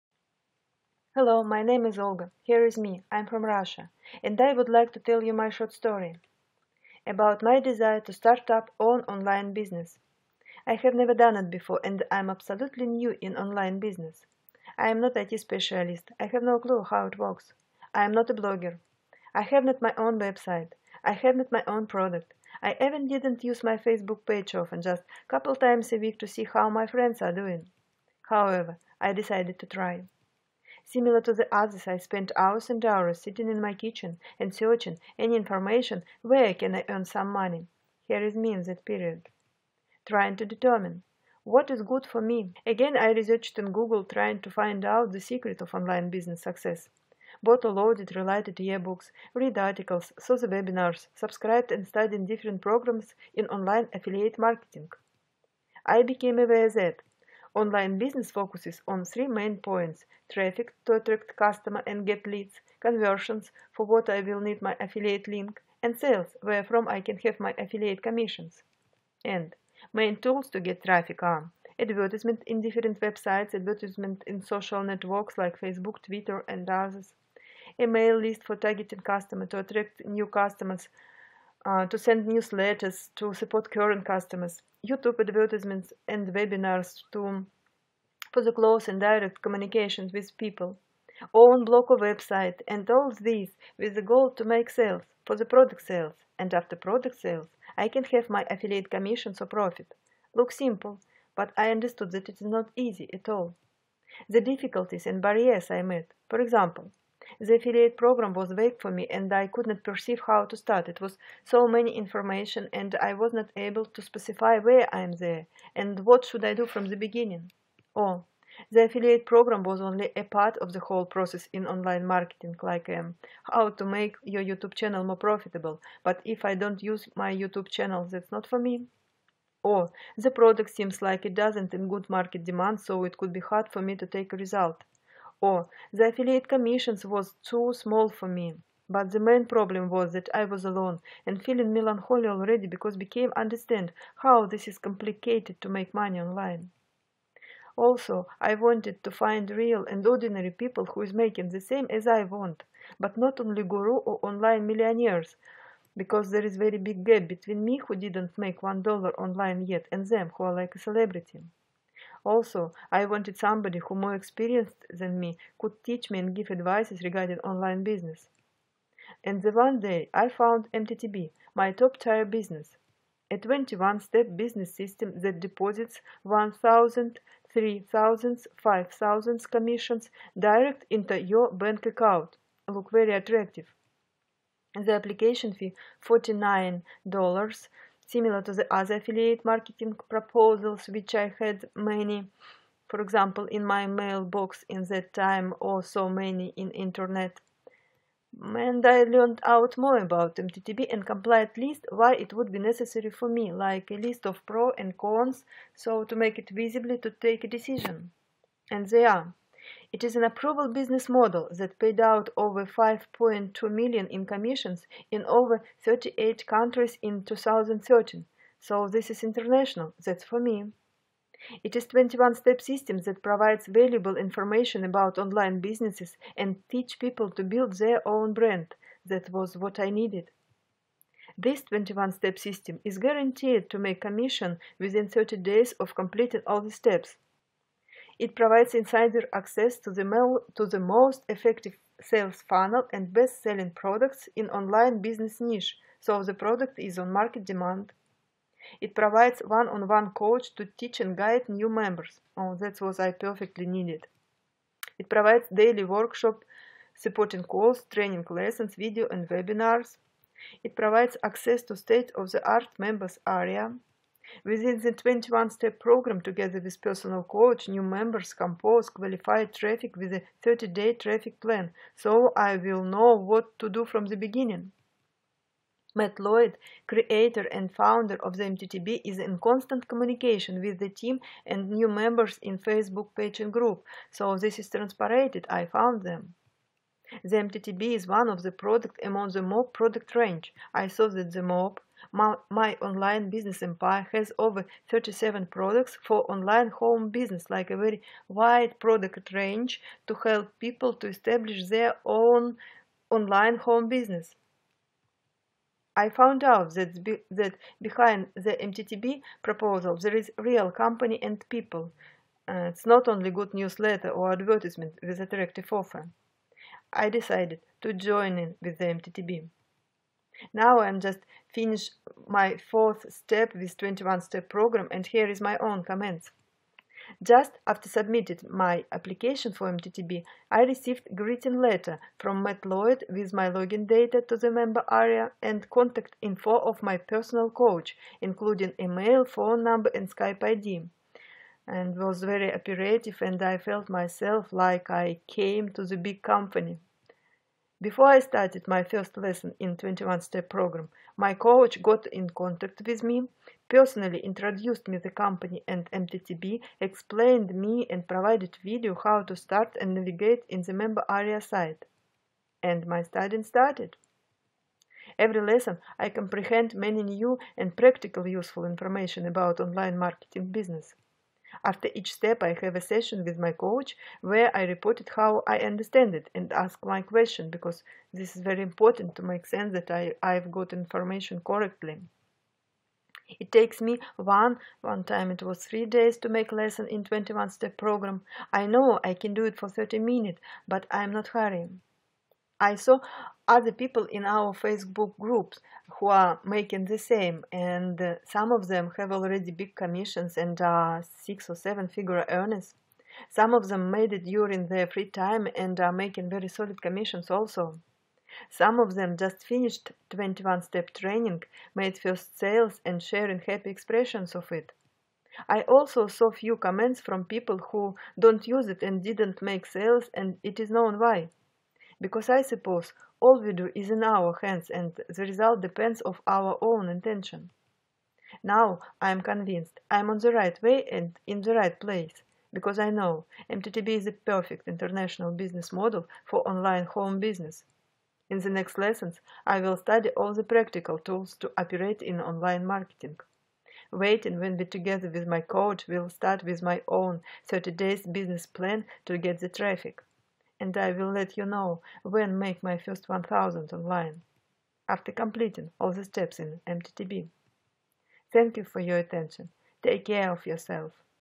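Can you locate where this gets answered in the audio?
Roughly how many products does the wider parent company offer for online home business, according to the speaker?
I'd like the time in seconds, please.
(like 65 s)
294 s.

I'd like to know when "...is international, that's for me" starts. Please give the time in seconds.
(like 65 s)
219 s.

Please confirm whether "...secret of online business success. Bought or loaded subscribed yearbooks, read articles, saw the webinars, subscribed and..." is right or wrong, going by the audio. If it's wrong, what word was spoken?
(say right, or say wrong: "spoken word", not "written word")
wrong: "related", not "subscribed".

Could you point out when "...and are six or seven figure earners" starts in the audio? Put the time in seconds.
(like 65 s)
400 s.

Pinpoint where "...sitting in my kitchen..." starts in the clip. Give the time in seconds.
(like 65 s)
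33 s.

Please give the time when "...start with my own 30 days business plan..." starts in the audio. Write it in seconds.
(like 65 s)
446 s.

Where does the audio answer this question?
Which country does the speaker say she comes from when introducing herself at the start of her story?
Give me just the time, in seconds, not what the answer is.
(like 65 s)
3 s.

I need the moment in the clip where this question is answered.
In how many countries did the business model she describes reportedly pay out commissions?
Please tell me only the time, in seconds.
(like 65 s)
215 s.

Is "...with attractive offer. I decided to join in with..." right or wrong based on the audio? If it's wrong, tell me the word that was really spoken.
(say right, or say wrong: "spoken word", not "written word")
right.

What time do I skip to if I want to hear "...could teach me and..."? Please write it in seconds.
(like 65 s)
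165 s.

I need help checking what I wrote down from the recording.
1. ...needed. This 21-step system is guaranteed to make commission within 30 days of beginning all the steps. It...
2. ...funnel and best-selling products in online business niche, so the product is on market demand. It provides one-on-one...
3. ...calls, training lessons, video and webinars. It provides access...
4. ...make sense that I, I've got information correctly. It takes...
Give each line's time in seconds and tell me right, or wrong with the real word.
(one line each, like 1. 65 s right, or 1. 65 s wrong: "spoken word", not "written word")
1. 229 s wrong: "completing", not "beginning"
2. 242 s right
3. 257 s right
4. 379 s right.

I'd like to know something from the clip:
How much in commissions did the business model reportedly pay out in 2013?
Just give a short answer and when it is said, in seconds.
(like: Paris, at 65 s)
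5.2 million, at 212 s.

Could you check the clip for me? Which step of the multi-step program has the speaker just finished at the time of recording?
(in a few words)
fourth.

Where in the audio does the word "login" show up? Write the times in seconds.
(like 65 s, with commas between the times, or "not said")
333 s.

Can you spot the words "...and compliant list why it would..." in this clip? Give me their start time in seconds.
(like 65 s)
200 s.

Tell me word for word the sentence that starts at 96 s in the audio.
And after product sales, I can have my affiliate commissions or profit.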